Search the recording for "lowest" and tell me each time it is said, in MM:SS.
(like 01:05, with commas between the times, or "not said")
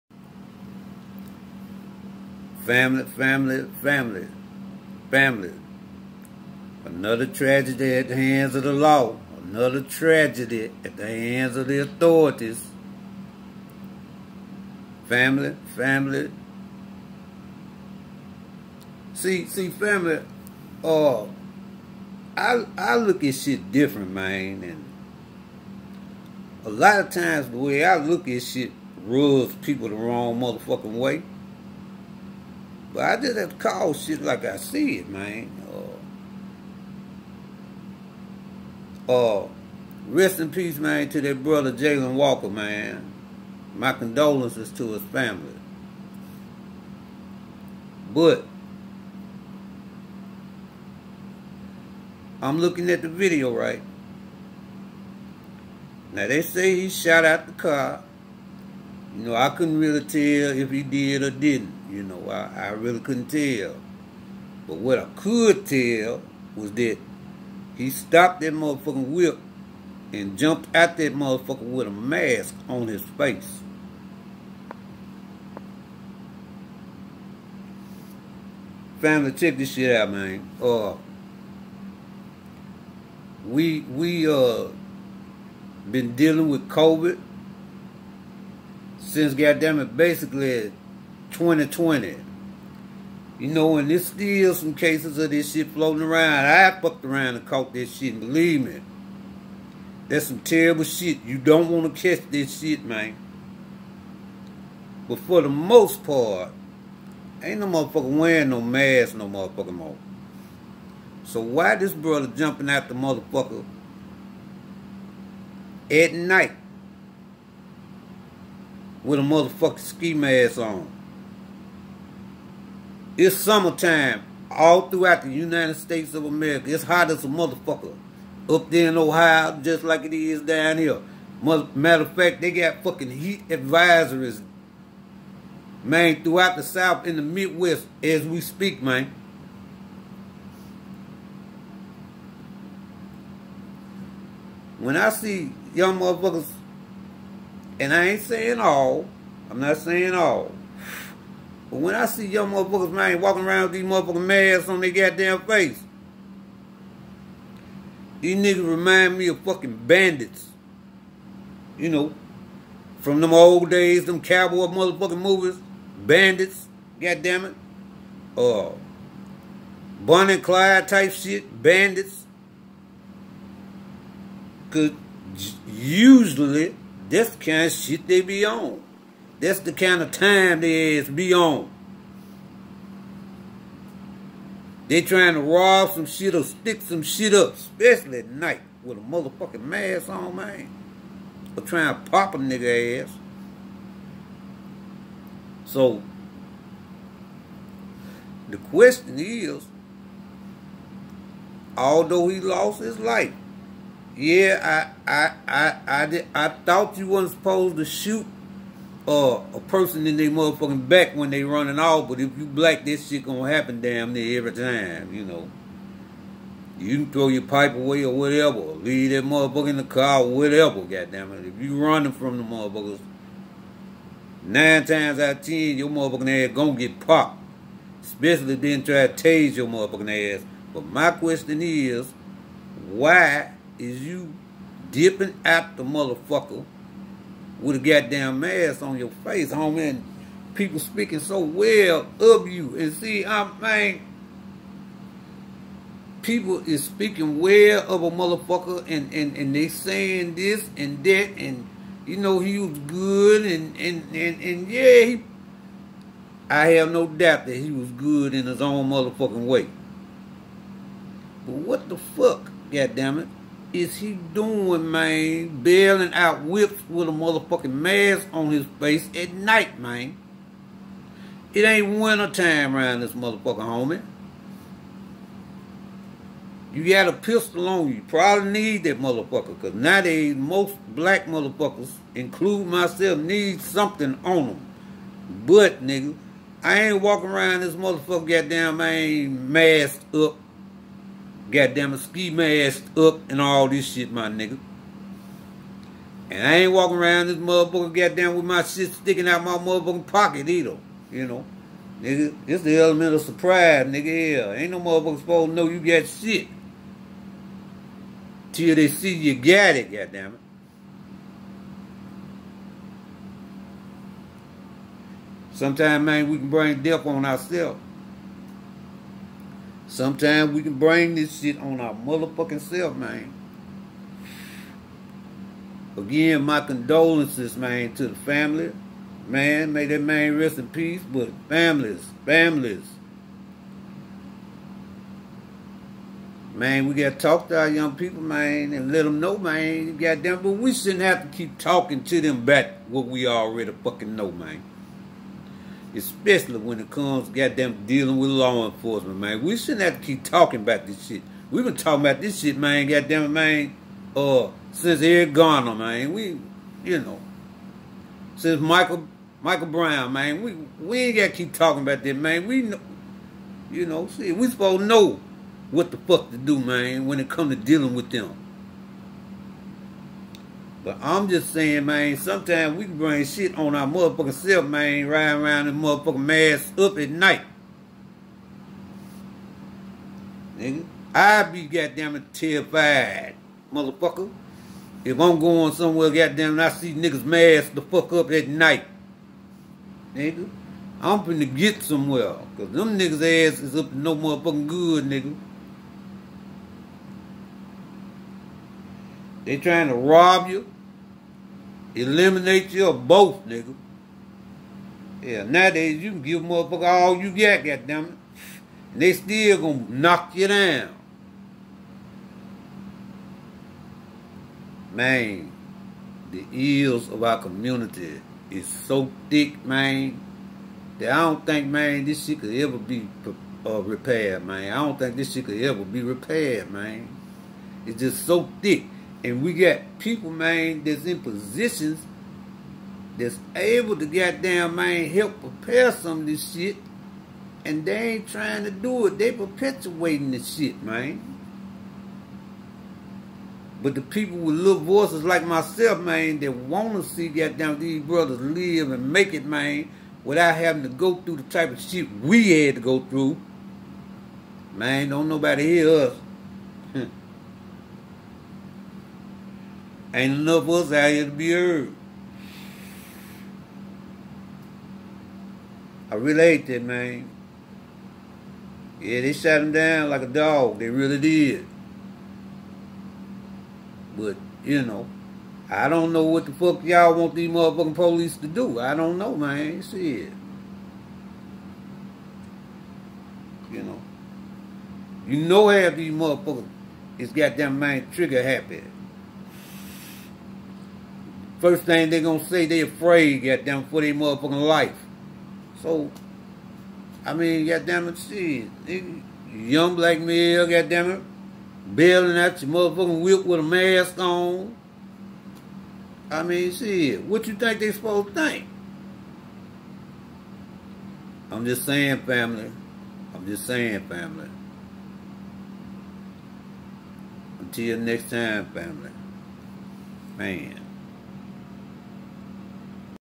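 not said.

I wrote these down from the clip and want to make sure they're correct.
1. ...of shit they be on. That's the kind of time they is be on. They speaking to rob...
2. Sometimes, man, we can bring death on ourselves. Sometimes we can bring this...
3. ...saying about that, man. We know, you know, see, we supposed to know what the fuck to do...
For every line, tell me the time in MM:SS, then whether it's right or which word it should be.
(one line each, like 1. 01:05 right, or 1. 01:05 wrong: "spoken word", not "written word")
1. 02:57 wrong: "trying", not "speaking"
2. 05:15 right
3. 06:01 wrong: "talking", not "saying".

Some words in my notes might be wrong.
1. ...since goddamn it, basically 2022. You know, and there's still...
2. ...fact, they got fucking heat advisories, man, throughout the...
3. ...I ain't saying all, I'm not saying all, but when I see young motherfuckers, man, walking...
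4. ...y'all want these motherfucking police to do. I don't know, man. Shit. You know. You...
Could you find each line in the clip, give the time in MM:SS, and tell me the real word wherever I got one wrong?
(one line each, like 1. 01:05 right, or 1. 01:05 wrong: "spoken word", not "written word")
1. 01:28 wrong: "2020", not "2022"
2. 02:12 right
3. 02:27 right
4. 07:56 right.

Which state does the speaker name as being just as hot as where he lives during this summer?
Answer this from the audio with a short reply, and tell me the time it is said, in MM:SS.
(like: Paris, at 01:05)
Ohio, at 02:08.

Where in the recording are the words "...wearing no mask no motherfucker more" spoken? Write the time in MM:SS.
01:48.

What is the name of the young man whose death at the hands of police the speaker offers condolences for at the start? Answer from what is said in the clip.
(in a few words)
Jayland Walker.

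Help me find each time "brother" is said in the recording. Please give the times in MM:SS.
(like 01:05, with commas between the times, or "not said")
00:41, 01:51, 07:28.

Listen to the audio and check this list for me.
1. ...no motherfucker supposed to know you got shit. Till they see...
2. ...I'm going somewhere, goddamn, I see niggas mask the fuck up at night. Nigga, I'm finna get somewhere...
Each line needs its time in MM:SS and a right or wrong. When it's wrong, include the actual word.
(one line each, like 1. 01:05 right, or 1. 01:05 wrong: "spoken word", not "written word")
1. 05:04 right
2. 06:25 right.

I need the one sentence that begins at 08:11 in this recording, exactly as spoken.
First thing they gonna say they afraid, goddamn, for their motherfucking life.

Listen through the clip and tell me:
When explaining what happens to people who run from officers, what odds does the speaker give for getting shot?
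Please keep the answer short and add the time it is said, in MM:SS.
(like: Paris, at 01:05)
9 out of 10, at 03:44.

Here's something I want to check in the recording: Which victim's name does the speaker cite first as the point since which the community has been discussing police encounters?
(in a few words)
Eric Garner.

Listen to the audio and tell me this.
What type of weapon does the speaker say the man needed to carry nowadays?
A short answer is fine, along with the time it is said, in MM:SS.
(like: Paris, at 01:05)
pistol, at 04:37.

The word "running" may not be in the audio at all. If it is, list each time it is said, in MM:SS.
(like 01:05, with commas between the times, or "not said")
03:31, 03:41.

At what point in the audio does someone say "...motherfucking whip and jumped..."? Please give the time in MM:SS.
01:08.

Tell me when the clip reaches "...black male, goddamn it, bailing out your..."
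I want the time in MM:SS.
08:19.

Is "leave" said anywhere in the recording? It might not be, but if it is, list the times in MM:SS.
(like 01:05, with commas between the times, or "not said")
03:38.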